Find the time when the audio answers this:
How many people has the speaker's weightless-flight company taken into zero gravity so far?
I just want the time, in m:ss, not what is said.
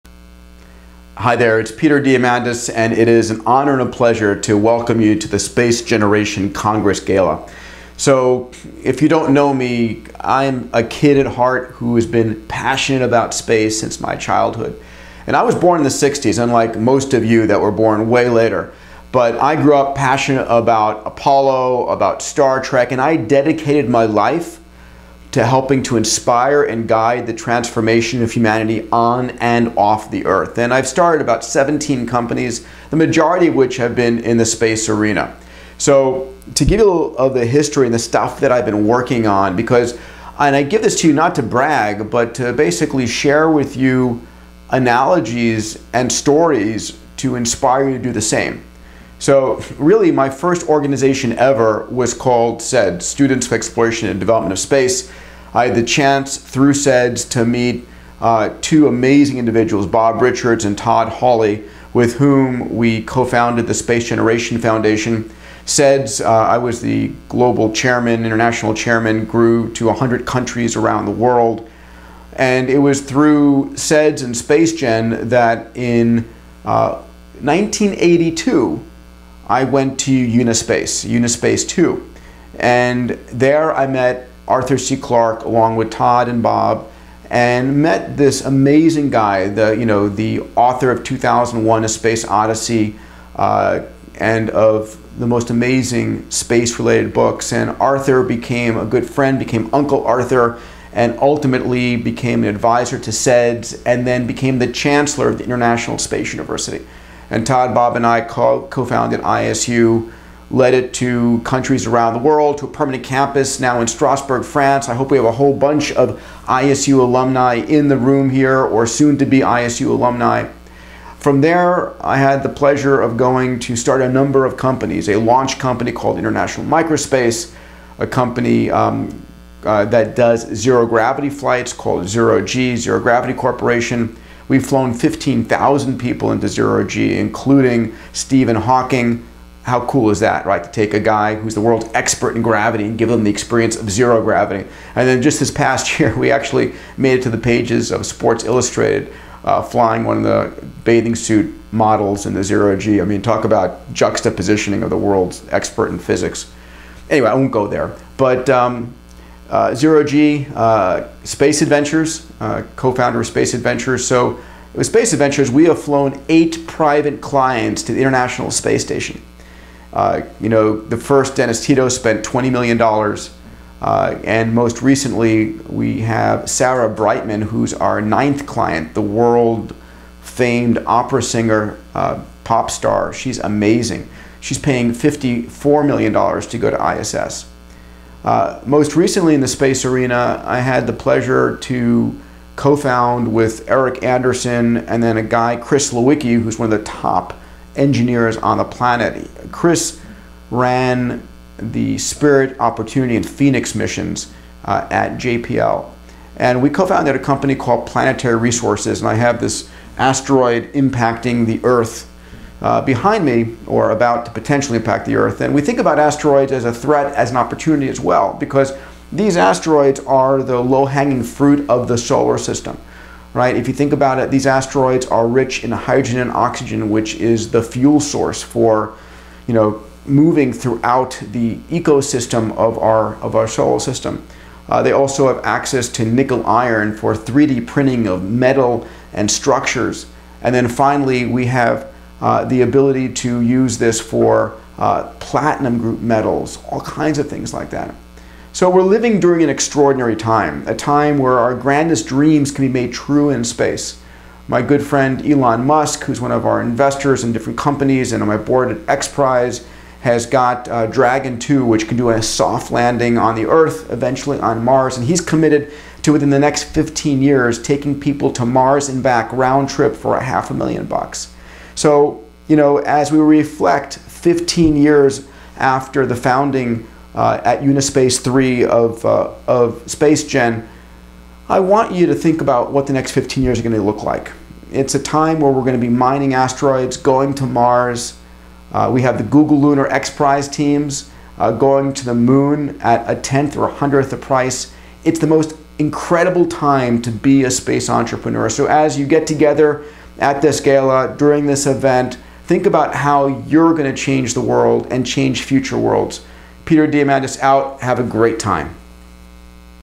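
2:14.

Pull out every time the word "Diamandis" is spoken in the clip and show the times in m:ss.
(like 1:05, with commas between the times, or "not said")
0:02, 5:06.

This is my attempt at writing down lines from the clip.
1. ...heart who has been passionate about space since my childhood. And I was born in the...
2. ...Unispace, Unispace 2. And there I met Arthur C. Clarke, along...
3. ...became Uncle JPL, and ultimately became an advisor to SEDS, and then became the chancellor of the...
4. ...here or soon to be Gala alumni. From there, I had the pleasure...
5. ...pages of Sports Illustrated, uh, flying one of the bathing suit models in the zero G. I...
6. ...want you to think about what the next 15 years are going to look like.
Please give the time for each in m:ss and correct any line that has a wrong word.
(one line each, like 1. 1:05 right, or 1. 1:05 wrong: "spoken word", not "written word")
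1. 0:11 right
2. 1:20 right
3. 1:39 wrong: "Arthur", not "JPL"
4. 1:58 wrong: "ISU", not "Gala"
5. 2:27 right
6. 4:41 right.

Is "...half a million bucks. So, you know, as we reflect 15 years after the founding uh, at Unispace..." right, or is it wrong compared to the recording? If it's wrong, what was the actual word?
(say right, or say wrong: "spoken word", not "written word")
right.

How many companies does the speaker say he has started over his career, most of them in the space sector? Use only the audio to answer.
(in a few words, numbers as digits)
17.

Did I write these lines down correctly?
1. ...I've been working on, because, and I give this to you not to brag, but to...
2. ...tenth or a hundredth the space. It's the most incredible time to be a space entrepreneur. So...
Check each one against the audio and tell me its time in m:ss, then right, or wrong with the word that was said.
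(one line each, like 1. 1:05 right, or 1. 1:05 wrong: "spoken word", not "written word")
1. 0:38 right
2. 4:53 wrong: "price", not "space".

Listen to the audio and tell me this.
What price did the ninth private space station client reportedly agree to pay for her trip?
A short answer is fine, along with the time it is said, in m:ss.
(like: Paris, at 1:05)
$54 million, at 3:04.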